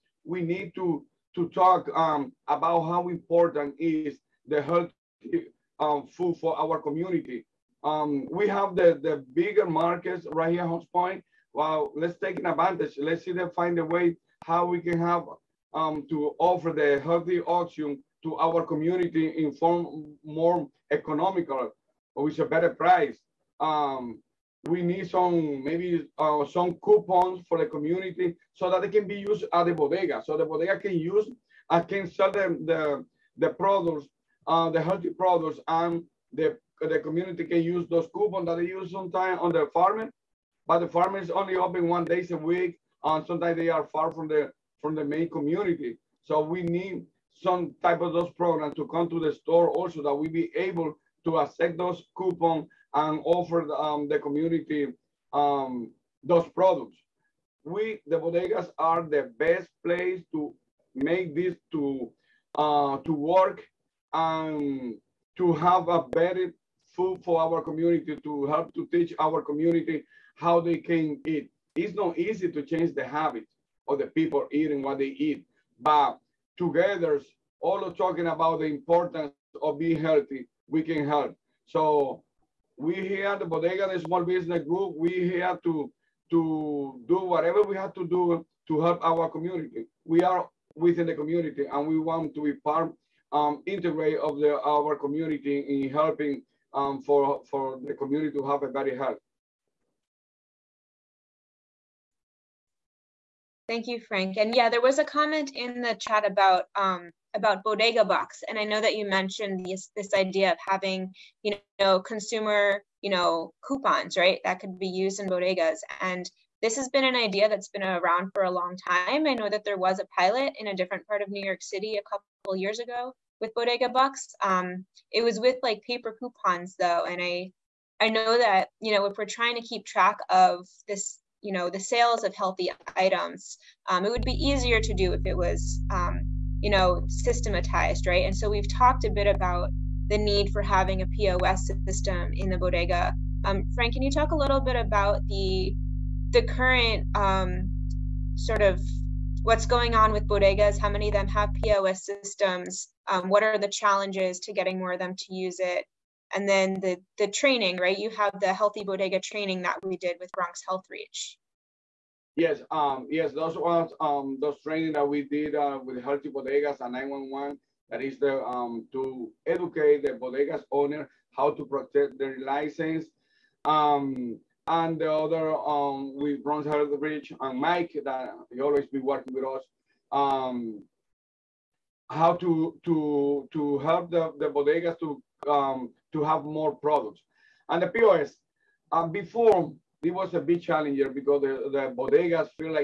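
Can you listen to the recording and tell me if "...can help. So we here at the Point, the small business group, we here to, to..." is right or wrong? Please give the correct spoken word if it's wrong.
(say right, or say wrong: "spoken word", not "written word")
wrong: "Bodega", not "Point".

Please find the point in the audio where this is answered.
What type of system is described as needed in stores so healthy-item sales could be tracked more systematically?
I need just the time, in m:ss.
2:21.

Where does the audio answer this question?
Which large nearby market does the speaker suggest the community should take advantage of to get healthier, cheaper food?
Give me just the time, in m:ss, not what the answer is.
0:10.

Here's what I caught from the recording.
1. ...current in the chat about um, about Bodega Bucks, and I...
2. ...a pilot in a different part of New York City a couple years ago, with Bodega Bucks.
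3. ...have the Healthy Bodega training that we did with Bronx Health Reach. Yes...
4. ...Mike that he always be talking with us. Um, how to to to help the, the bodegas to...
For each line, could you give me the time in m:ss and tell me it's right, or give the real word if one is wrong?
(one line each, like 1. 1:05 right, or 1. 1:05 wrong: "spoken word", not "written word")
1. 1:45 wrong: "comment", not "current"
2. 1:59 right
3. 2:38 right
4. 2:57 wrong: "working", not "talking".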